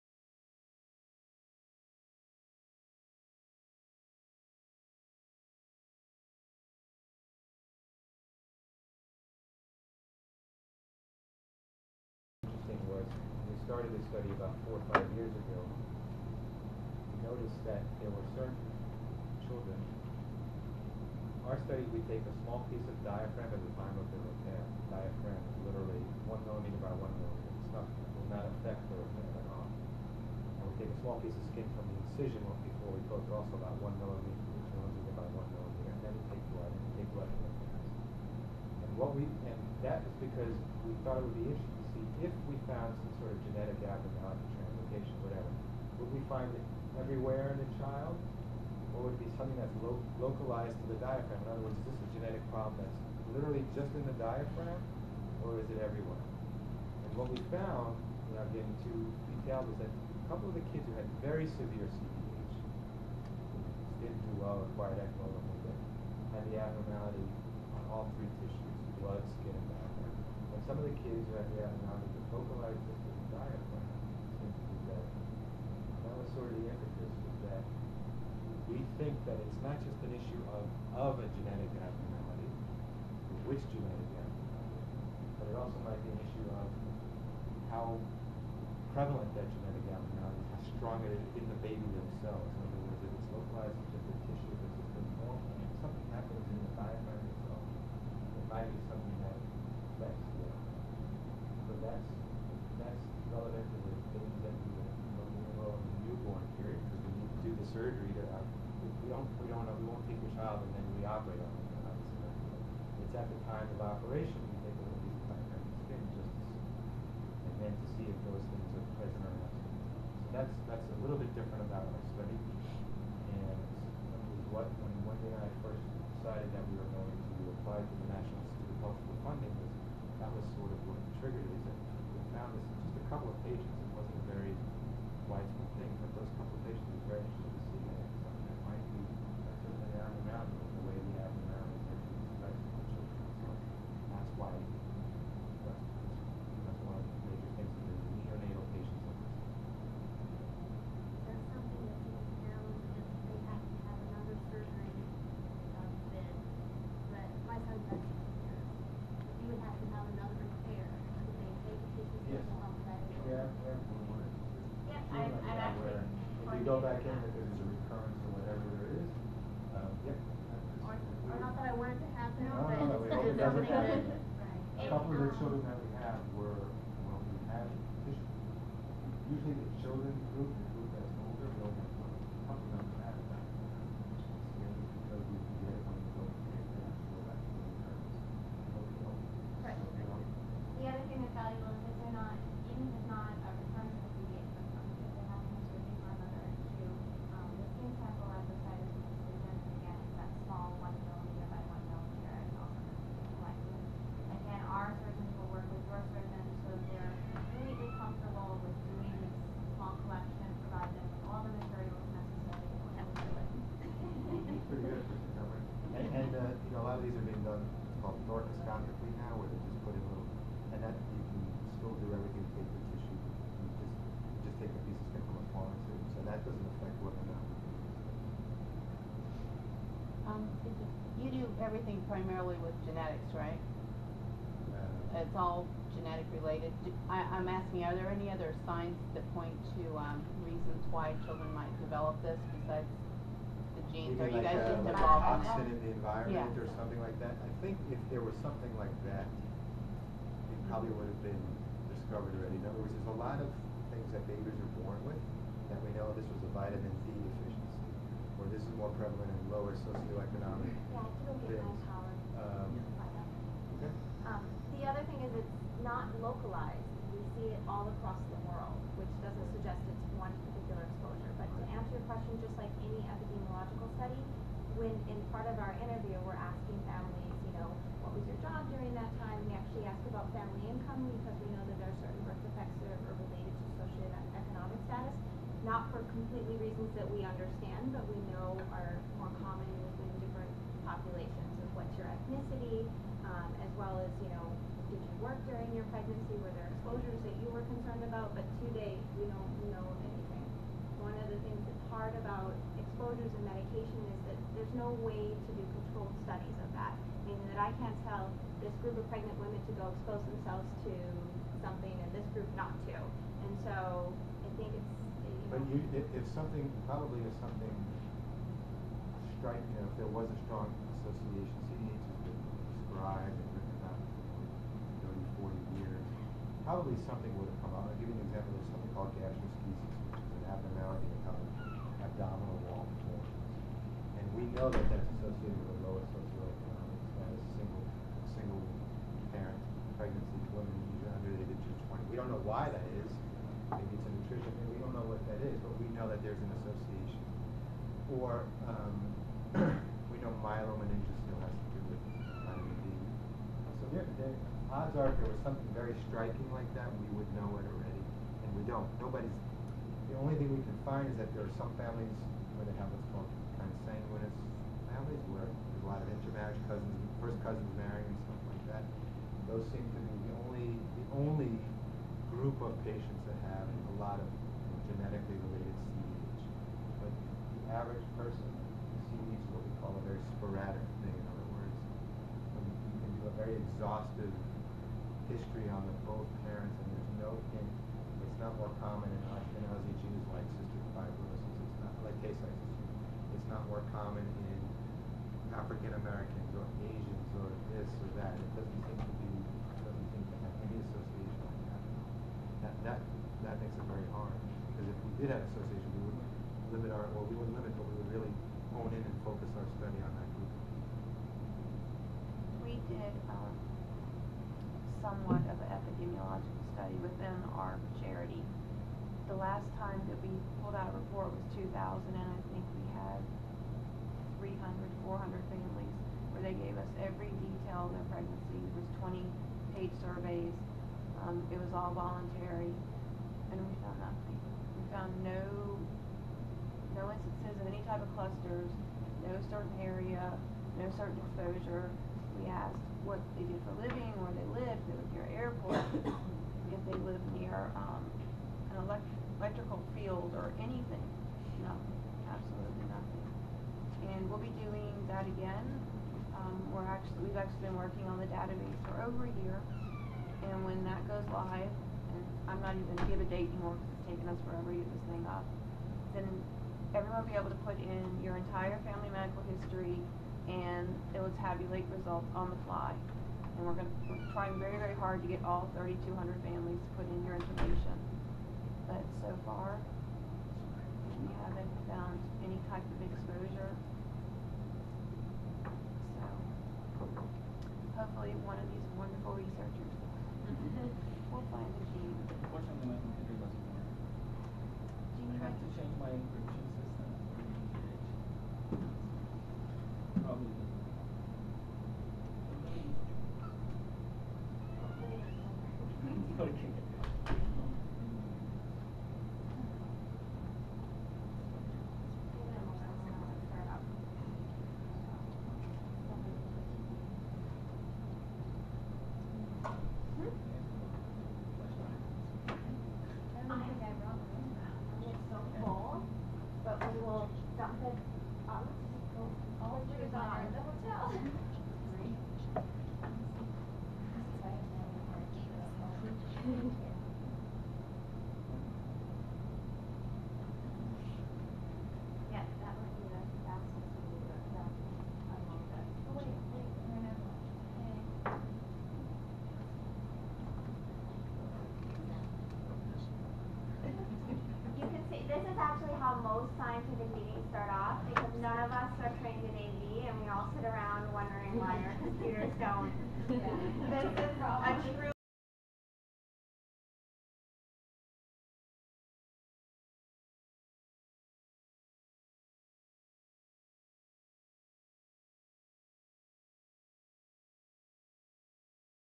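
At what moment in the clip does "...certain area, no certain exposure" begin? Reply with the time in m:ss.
7:19.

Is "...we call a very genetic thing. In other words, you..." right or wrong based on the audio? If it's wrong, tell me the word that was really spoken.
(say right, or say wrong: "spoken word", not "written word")
wrong: "sporadic", not "genetic".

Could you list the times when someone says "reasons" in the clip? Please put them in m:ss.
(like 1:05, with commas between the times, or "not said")
4:00, 4:46.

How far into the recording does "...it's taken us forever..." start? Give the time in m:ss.
7:43.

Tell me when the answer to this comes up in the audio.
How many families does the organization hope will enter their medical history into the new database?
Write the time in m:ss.
7:55.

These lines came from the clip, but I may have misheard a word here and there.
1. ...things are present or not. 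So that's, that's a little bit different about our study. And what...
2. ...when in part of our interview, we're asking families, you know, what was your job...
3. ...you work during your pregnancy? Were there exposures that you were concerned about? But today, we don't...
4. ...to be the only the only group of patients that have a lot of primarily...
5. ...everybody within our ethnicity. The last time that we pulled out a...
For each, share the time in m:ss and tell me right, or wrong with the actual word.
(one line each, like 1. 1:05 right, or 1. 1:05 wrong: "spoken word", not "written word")
1. 1:58 right
2. 4:34 right
3. 4:54 right
4. 6:09 wrong: "genetically", not "primarily"
5. 6:56 wrong: "charity", not "ethnicity".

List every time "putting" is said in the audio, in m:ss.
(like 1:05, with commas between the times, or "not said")
not said.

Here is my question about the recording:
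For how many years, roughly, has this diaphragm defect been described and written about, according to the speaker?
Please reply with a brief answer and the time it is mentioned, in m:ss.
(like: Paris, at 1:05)
30 to 40 years, at 5:25.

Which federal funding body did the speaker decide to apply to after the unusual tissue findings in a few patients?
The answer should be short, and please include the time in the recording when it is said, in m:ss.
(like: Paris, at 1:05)
National Institute of Health, at 2:08.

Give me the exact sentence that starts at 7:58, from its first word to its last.
But so far, we haven't found any type of exposure.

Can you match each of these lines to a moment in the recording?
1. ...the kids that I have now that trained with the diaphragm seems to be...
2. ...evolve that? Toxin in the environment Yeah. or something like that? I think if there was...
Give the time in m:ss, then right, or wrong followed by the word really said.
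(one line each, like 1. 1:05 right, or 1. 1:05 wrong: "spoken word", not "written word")
1. 1:10 wrong: "vocalized", not "trained"
2. 4:04 right.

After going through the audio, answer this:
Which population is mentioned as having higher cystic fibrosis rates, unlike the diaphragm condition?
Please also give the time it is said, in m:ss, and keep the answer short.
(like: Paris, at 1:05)
Ashkenazi Jews, at 6:29.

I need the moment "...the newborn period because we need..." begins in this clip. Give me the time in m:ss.
1:45.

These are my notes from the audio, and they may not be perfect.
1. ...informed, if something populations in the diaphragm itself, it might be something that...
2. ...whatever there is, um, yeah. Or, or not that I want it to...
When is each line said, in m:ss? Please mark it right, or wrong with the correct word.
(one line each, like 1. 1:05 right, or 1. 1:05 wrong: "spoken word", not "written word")
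1. 1:34 wrong: "happens", not "populations"
2. 2:48 right.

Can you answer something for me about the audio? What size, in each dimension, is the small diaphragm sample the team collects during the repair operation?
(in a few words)
1 millimeter.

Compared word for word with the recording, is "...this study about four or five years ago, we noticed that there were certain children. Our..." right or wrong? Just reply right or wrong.
right.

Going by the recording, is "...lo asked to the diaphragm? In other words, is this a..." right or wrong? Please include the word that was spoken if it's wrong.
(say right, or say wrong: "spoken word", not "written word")
wrong: "localized", not "asked".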